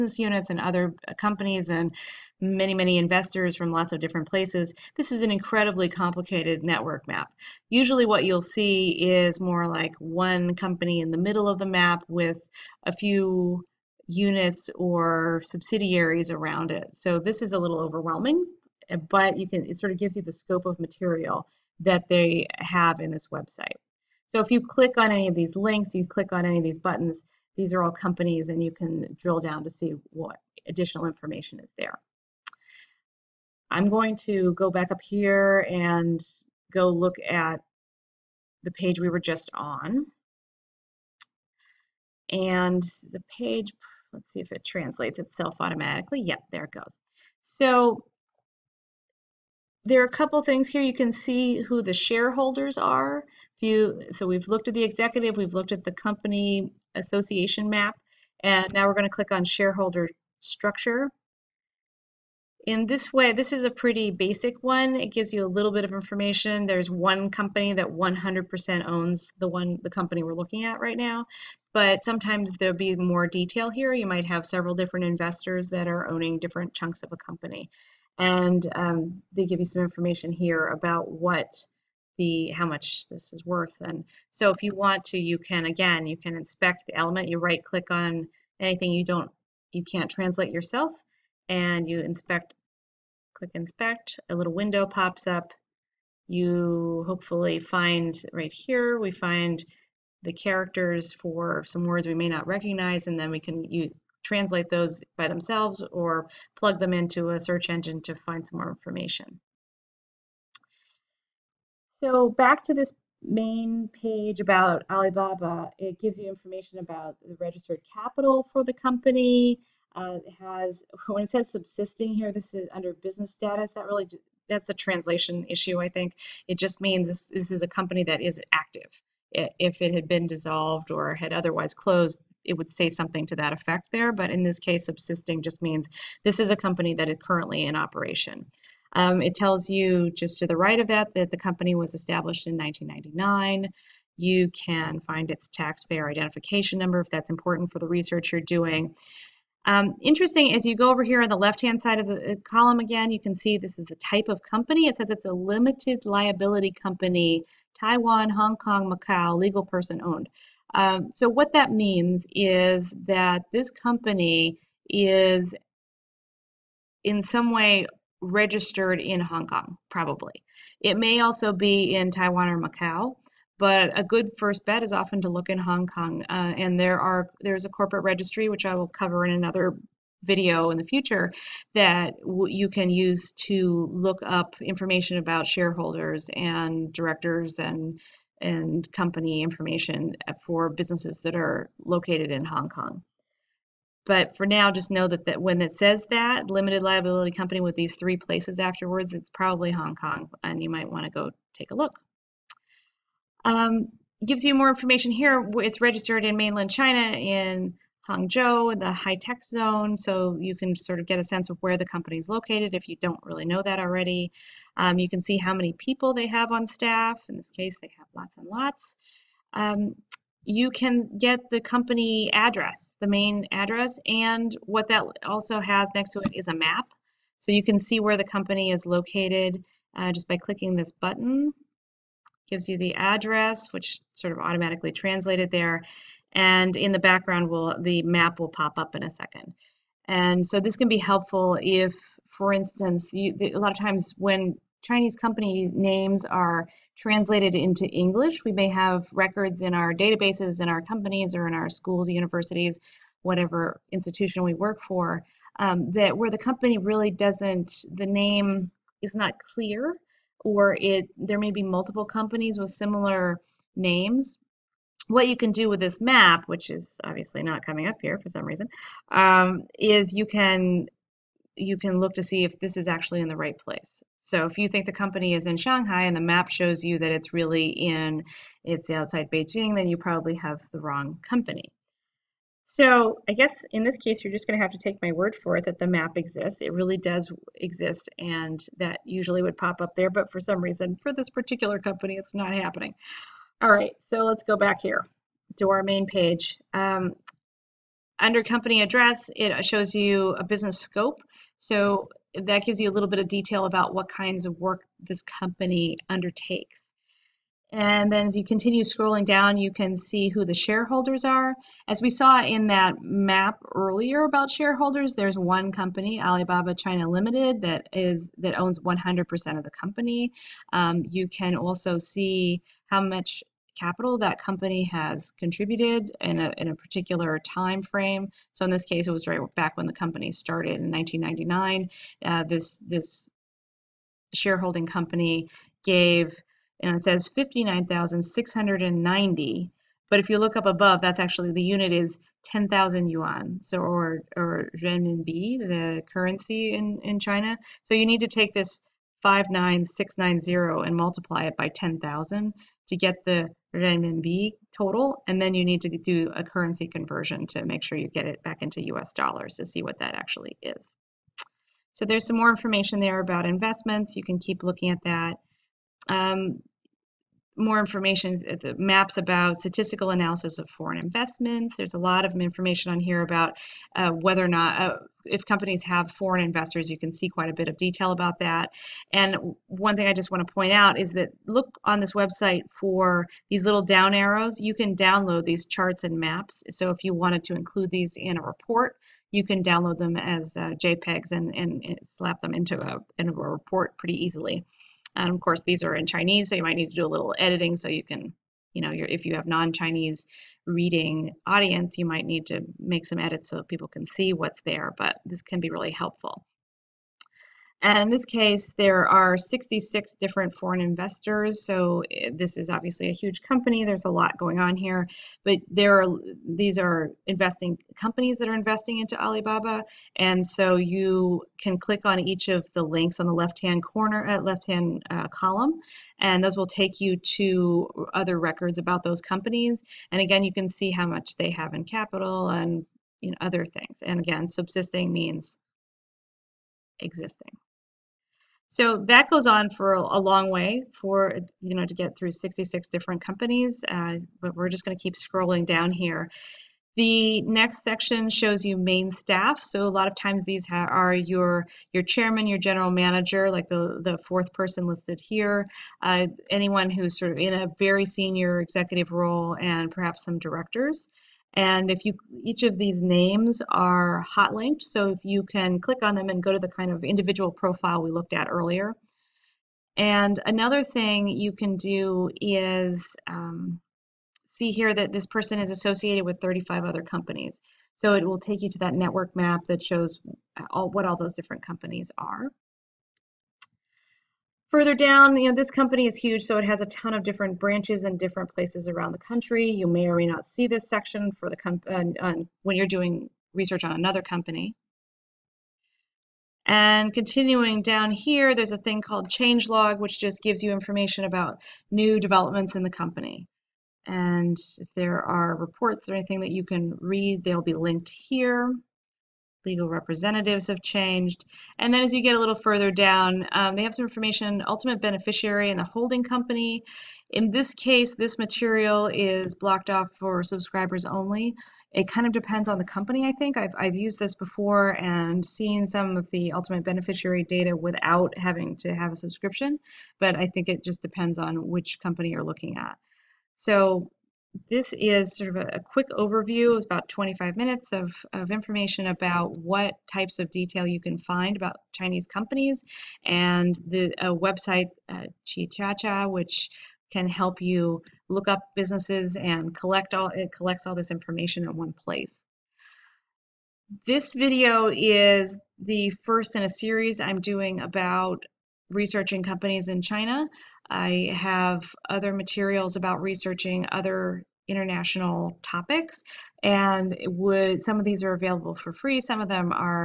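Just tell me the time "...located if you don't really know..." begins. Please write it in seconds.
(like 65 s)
212 s.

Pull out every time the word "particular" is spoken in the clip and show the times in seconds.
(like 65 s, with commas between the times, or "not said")
291 s, 326 s.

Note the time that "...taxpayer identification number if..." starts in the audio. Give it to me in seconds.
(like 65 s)
145 s.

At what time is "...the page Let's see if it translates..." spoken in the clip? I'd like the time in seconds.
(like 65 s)
43 s.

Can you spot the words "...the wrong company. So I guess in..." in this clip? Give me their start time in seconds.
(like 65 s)
280 s.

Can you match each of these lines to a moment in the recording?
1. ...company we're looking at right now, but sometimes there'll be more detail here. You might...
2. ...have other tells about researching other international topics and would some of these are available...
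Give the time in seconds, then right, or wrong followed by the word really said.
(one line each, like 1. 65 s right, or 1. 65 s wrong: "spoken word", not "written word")
1. 69 s right
2. 561 s wrong: "materials", not "tells".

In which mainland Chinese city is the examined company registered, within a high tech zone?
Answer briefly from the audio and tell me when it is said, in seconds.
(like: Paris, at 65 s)
Hangzhou, at 208 s.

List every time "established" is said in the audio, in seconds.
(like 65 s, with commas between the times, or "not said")
141 s.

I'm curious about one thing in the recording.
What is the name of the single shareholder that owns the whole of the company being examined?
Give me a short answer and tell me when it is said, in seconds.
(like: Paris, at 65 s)
Alibaba China Limited, at 316 s.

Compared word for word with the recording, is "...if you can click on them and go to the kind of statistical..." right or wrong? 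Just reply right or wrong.
wrong.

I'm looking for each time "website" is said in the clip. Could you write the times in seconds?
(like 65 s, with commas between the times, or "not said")
23 s, 382 s, 544 s.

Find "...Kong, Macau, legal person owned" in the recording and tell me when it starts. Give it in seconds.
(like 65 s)
158 s.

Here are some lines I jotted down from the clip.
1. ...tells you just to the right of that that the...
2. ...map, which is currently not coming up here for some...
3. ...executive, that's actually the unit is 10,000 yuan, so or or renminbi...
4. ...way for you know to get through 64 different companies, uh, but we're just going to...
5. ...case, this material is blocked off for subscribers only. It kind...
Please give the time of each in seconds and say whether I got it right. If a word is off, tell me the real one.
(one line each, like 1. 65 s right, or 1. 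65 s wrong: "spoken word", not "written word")
1. 139 s right
2. 265 s wrong: "obviously", not "currently"
3. 340 s wrong: "above", not "executive"
4. 440 s wrong: "66", not "64"
5. 517 s right.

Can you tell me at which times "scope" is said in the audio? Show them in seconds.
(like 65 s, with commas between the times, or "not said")
20 s, 300 s.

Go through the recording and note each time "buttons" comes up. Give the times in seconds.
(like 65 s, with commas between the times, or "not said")
26 s, 230 s.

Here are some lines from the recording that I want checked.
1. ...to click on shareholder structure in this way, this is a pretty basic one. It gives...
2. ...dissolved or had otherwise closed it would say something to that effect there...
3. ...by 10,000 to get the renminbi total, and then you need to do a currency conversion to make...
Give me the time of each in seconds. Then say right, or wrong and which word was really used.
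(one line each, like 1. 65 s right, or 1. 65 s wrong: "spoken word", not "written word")
1. 59 s right
2. 130 s right
3. 351 s right.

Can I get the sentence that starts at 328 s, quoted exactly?
So in this case, it was right back when the company started in 1999.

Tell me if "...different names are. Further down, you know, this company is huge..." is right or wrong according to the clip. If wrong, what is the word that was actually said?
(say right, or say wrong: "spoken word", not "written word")
wrong: "companies", not "names".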